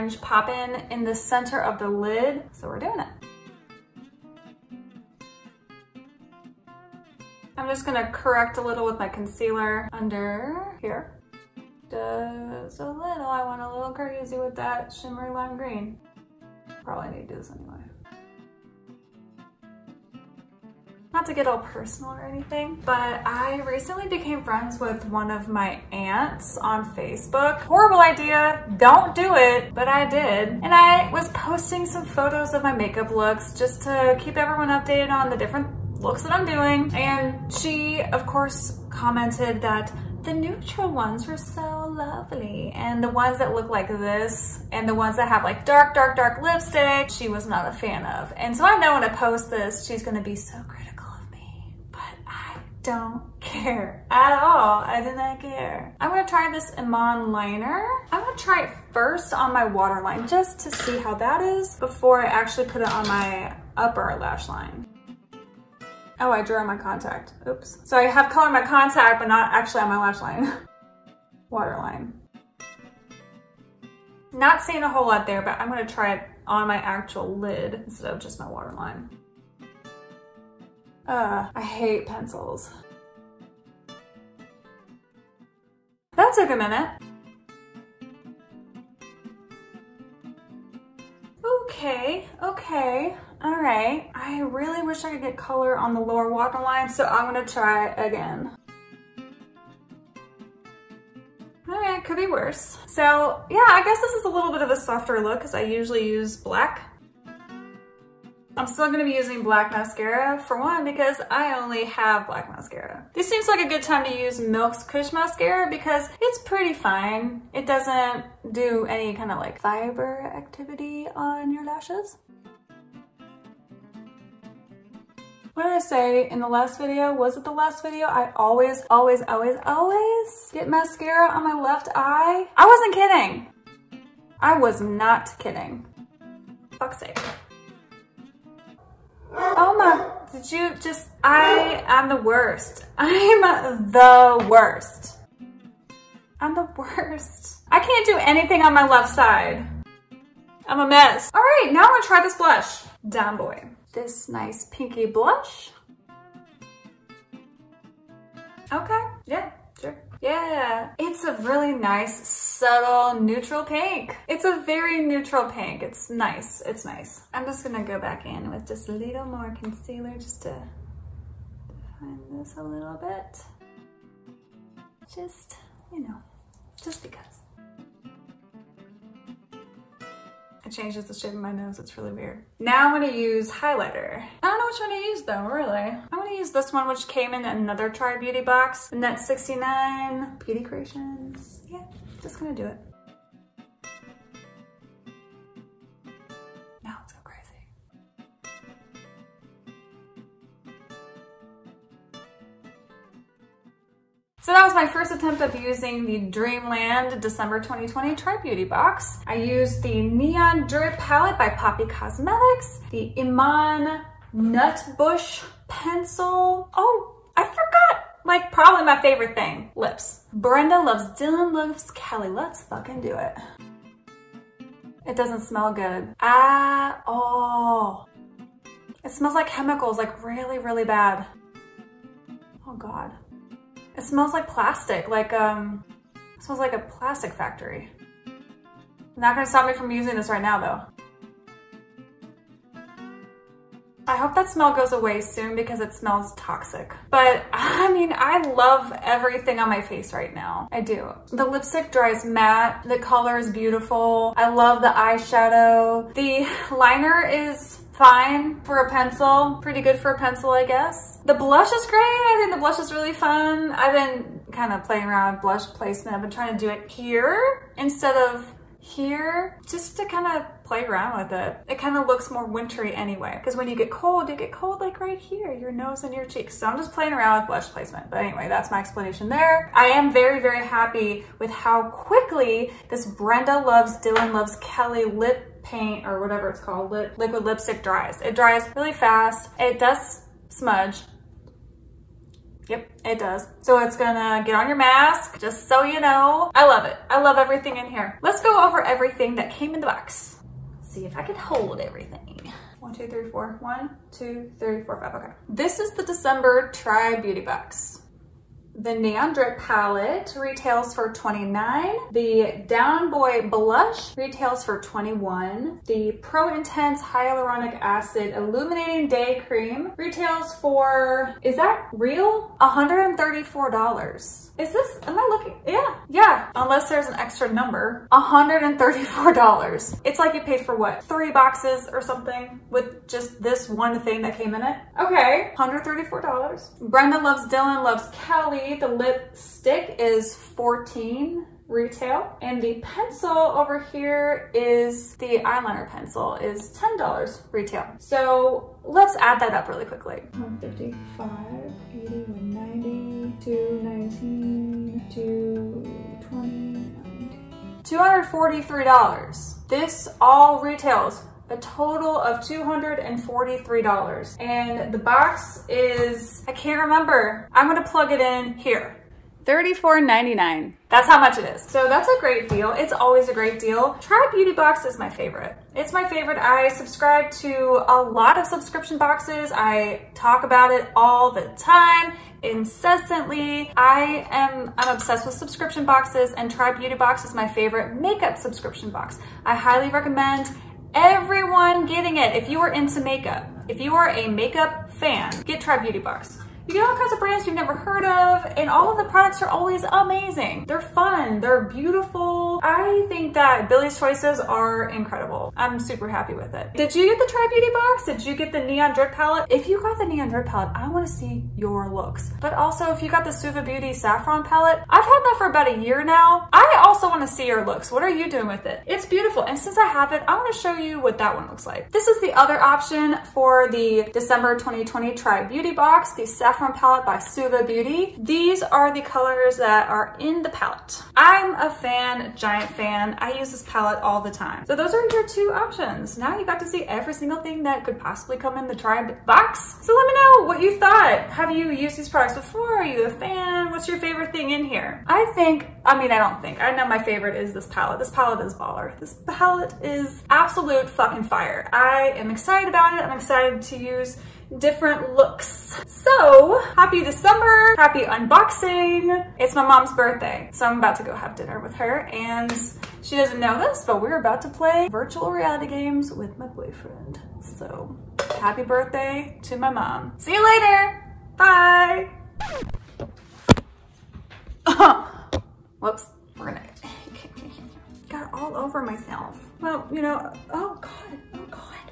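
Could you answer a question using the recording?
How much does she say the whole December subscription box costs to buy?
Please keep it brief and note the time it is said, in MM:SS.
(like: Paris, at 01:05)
$34.99, at 06:09.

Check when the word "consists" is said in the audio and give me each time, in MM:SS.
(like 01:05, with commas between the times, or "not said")
not said.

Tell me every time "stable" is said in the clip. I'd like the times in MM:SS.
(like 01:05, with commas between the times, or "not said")
not said.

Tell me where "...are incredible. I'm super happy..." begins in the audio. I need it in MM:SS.
06:44.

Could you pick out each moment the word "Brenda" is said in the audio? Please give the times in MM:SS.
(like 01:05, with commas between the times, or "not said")
03:40, 04:43, 05:36.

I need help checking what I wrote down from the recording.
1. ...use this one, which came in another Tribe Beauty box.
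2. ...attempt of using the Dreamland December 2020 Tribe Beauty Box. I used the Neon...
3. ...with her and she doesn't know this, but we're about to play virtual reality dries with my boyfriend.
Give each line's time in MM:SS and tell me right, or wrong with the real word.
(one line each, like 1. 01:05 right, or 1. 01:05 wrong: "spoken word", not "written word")
1. 03:06 right
2. 03:25 right
3. 07:41 wrong: "games", not "dries".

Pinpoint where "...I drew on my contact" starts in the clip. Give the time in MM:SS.
01:06.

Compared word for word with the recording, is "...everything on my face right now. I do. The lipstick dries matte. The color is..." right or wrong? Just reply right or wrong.
right.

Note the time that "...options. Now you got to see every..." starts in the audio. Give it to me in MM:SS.
07:15.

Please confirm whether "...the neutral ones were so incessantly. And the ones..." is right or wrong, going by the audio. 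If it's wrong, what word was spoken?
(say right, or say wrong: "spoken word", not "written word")
wrong: "lovely", not "incessantly".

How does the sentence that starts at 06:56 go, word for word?
I also wanna see your looks.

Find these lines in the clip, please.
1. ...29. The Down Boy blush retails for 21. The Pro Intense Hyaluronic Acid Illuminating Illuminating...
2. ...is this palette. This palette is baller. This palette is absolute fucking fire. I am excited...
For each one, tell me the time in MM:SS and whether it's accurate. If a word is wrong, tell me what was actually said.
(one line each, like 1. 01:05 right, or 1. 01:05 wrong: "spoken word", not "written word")
1. 05:11 wrong: "Day", not "Illuminating"
2. 07:27 right.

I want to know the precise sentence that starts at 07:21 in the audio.
Have you used these products before?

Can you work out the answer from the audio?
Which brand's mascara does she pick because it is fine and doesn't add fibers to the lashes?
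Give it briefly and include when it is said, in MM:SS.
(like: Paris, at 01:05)
Milk, at 01:54.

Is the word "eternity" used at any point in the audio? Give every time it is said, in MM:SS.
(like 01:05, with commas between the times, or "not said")
not said.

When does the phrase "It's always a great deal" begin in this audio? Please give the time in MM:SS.
06:12.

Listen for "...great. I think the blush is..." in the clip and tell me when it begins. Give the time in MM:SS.
04:21.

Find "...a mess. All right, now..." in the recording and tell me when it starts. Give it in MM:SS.
02:30.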